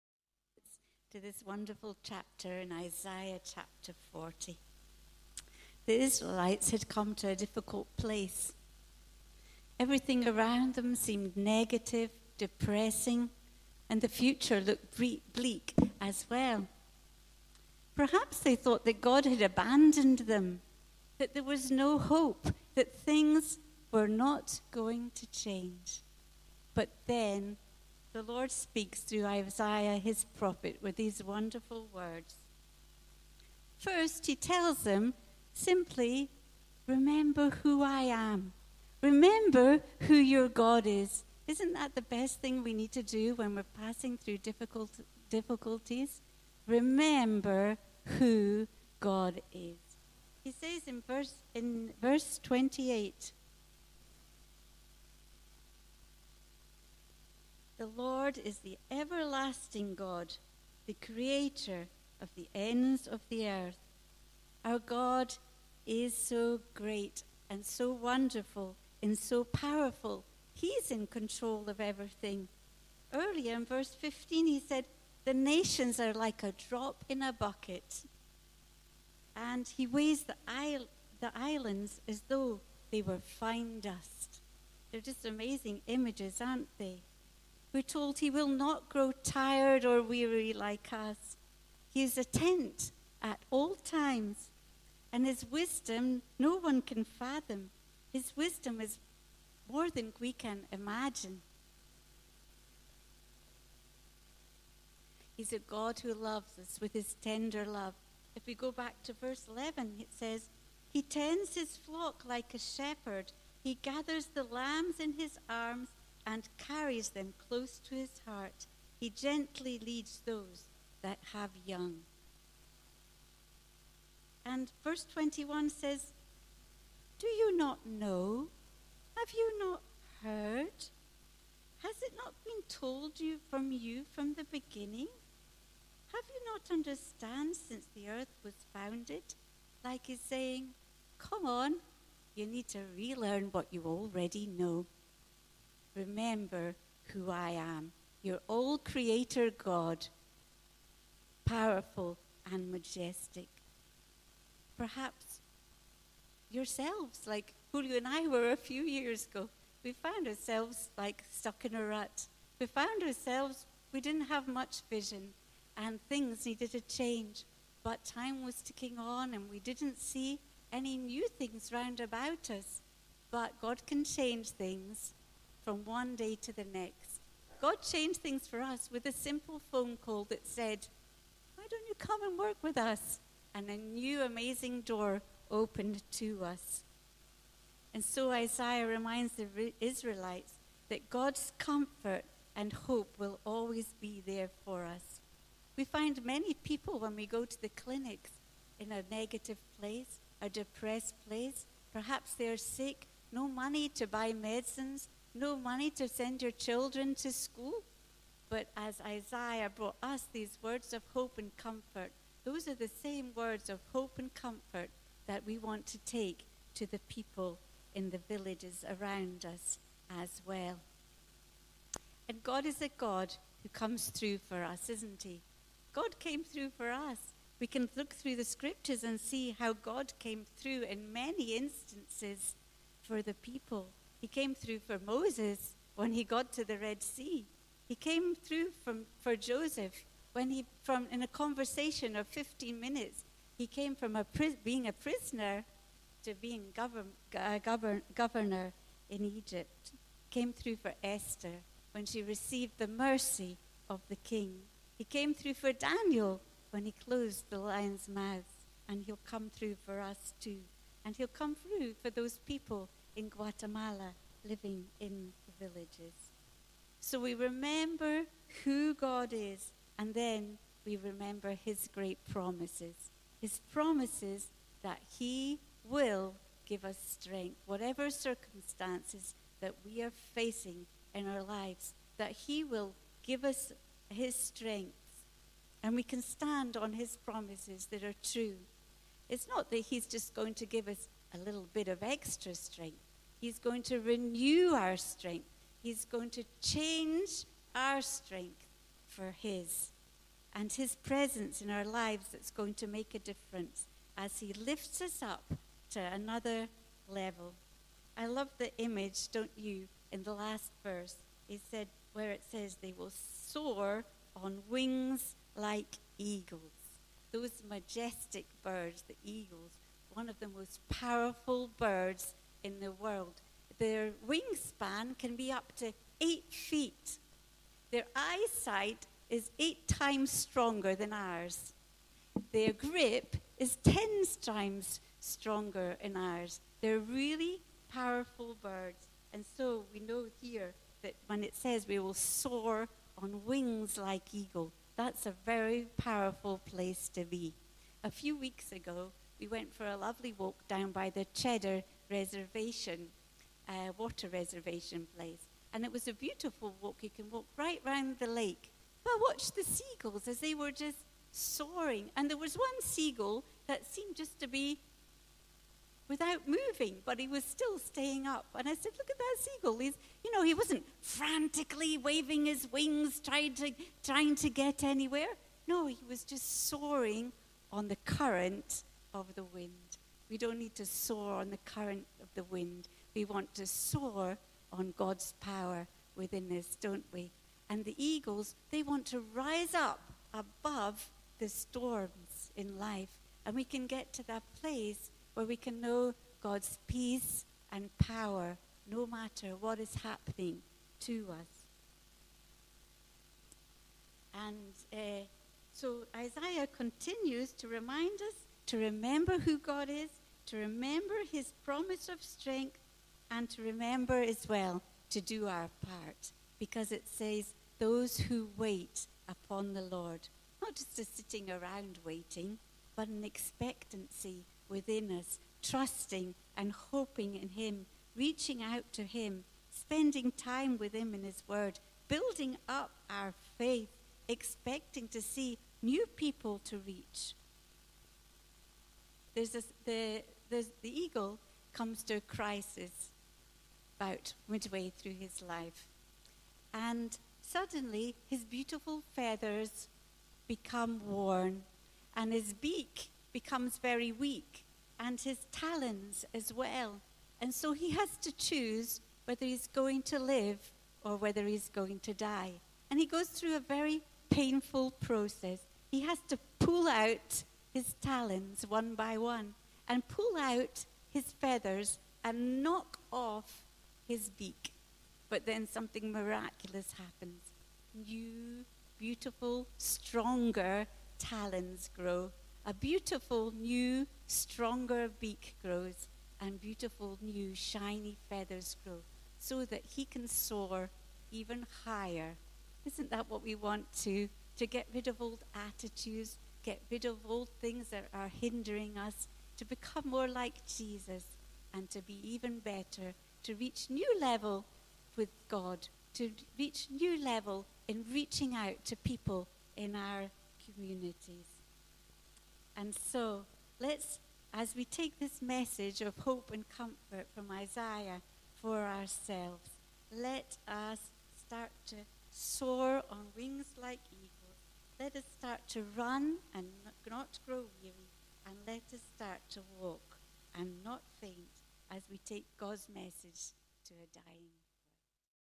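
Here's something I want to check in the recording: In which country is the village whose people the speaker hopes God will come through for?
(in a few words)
Guatemala.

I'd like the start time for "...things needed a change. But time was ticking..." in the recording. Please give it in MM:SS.
02:46.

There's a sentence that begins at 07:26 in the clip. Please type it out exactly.
And suddenly, his beautiful feathers become worn, and his beak becomes very weak, and his talons as well.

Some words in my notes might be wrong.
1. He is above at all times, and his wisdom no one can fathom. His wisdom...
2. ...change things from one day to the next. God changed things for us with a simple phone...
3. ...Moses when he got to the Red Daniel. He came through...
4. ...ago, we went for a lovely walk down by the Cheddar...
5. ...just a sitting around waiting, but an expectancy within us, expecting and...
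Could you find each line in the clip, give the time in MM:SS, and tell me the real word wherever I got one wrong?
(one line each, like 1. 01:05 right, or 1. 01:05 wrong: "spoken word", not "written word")
1. 01:31 wrong: "attentive", not "above"
2. 02:54 right
3. 03:54 wrong: "Sea", not "Daniel"
4. 05:48 right
5. 07:00 wrong: "trusting", not "expecting".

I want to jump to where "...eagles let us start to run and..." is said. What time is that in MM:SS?
08:44.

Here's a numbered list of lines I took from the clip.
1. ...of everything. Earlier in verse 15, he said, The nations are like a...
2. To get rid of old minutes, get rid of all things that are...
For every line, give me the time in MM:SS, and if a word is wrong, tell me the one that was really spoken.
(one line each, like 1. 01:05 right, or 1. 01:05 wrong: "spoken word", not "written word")
1. 01:11 right
2. 08:14 wrong: "attitudes", not "minutes".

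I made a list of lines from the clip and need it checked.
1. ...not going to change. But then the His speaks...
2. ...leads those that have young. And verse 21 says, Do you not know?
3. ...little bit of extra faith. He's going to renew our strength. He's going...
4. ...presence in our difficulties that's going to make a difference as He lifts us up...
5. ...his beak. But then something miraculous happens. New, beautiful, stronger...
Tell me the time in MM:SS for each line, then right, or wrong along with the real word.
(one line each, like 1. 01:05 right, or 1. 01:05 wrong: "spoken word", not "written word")
1. 00:24 wrong: "Lord", not "His"
2. 01:59 right
3. 04:51 wrong: "strength", not "faith"
4. 05:00 wrong: "lives", not "difficulties"
5. 07:54 right.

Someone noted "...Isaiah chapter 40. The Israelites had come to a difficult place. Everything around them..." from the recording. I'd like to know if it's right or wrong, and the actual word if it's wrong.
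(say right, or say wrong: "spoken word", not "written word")
right.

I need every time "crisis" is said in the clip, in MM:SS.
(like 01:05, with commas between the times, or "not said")
07:22.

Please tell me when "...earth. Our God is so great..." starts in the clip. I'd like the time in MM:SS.
01:03.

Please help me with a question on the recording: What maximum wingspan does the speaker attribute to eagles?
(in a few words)
8 feet.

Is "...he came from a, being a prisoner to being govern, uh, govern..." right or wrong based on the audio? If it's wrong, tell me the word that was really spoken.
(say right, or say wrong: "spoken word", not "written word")
right.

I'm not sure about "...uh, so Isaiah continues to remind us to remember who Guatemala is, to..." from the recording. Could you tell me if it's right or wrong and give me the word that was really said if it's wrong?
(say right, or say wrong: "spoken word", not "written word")
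wrong: "God", not "Guatemala".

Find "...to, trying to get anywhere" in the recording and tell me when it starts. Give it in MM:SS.
06:13.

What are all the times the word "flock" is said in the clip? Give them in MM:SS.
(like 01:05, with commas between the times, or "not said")
01:51.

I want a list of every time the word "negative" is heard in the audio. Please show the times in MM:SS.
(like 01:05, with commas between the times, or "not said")
00:11, 03:19.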